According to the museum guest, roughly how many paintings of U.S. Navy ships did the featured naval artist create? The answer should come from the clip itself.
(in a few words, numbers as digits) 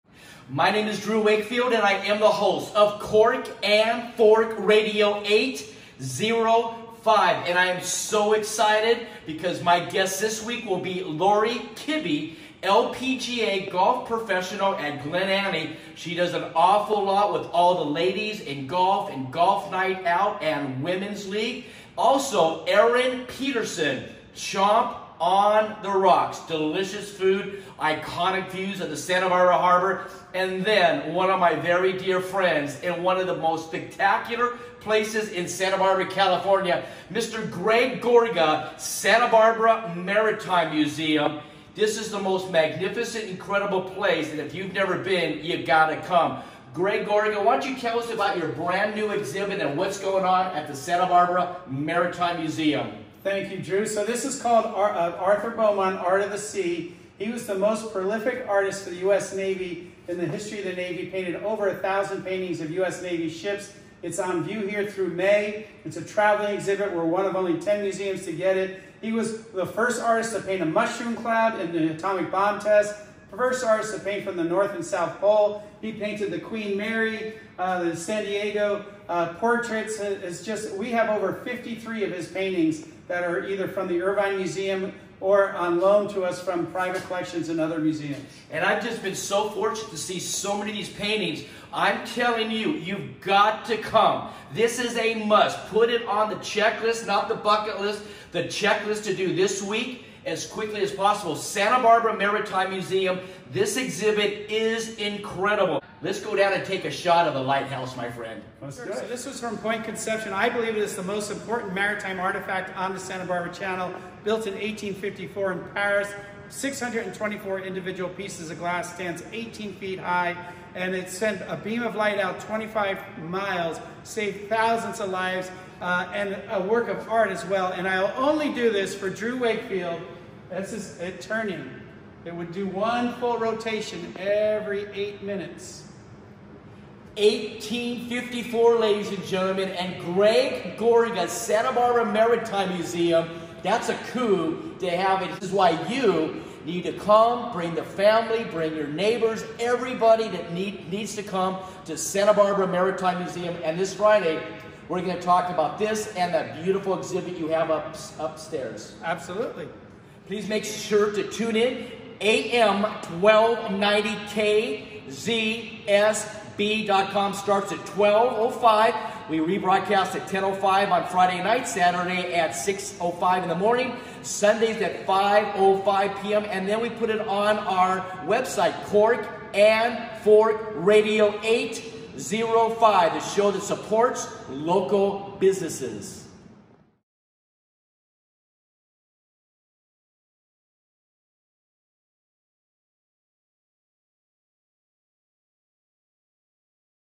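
over 1,000.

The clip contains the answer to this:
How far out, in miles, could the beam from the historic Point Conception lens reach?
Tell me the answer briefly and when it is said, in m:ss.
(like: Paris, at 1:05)
25 miles, at 2:02.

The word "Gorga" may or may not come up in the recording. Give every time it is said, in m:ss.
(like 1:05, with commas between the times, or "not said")
0:38, 0:47, 2:20.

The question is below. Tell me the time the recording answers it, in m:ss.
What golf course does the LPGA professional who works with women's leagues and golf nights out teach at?
0:15.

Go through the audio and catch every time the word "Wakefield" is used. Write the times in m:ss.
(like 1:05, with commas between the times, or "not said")
0:01, 2:09.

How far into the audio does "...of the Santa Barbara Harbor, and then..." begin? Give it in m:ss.
0:28.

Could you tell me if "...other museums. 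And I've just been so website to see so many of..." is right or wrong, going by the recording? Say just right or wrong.
wrong.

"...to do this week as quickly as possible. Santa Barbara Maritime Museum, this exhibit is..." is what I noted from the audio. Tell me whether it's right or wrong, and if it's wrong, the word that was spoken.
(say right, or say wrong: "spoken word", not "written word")
right.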